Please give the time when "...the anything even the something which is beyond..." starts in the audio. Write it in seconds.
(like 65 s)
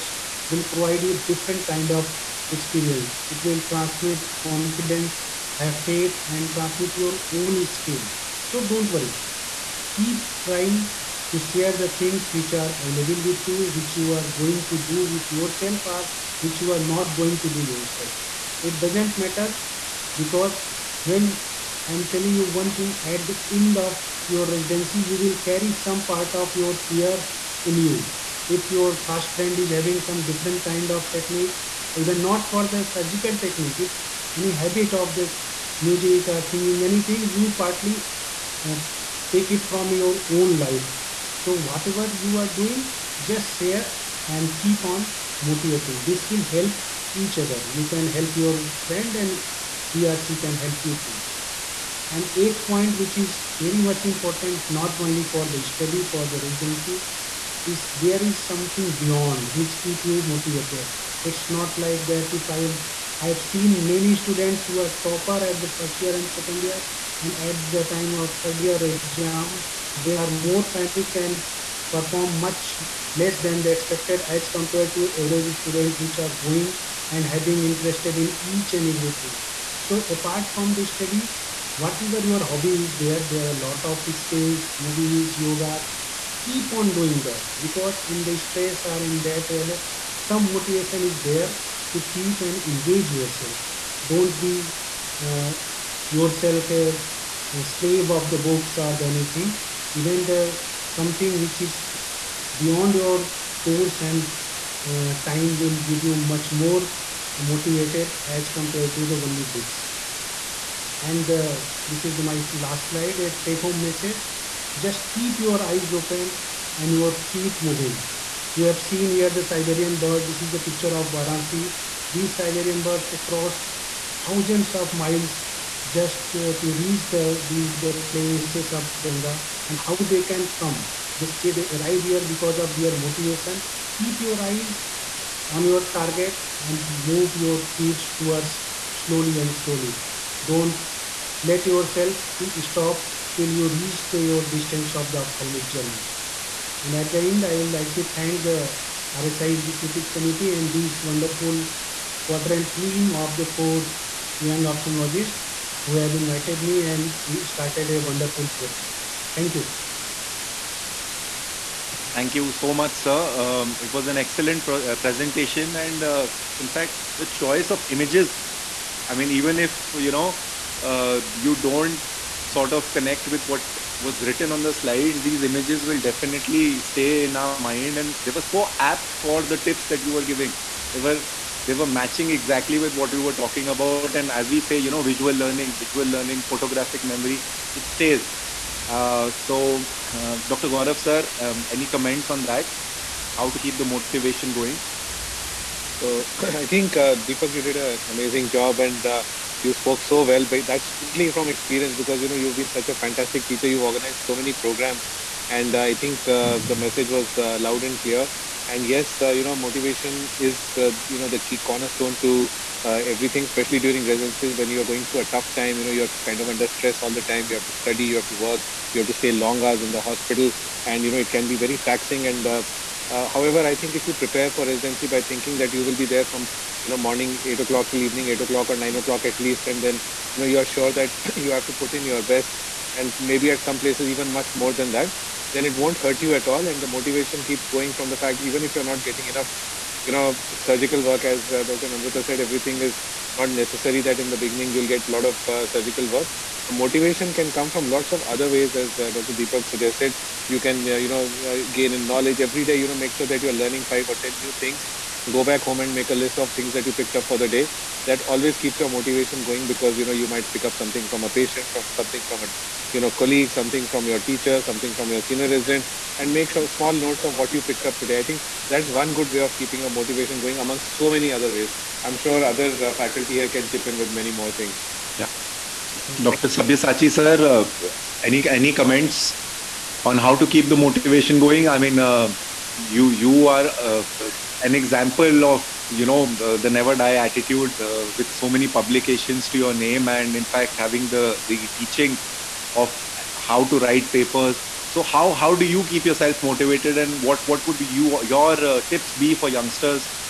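99 s.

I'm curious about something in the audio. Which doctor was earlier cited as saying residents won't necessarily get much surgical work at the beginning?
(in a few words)
Dr. Namrata.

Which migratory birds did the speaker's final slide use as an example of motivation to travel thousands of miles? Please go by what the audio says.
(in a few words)
Siberian birds.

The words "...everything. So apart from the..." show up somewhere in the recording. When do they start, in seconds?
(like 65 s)
78 s.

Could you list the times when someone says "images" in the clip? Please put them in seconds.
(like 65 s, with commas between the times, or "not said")
167 s, 175 s.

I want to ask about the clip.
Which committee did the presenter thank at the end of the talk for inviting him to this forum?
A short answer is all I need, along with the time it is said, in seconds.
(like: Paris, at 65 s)
RSI Executive Committee, at 149 s.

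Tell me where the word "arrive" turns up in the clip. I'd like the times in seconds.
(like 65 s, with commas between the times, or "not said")
131 s.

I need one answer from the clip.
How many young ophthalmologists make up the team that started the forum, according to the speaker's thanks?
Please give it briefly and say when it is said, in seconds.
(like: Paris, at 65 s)
4, at 153 s.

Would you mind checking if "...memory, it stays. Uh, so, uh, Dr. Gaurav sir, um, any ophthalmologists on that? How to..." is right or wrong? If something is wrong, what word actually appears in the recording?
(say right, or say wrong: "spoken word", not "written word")
wrong: "comments", not "ophthalmologists".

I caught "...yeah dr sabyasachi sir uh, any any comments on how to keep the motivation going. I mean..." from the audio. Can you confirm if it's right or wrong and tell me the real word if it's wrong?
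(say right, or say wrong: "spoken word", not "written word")
right.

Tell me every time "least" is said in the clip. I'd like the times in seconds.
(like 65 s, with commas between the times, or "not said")
229 s.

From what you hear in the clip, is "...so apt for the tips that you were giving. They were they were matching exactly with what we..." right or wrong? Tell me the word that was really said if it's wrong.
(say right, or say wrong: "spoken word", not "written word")
right.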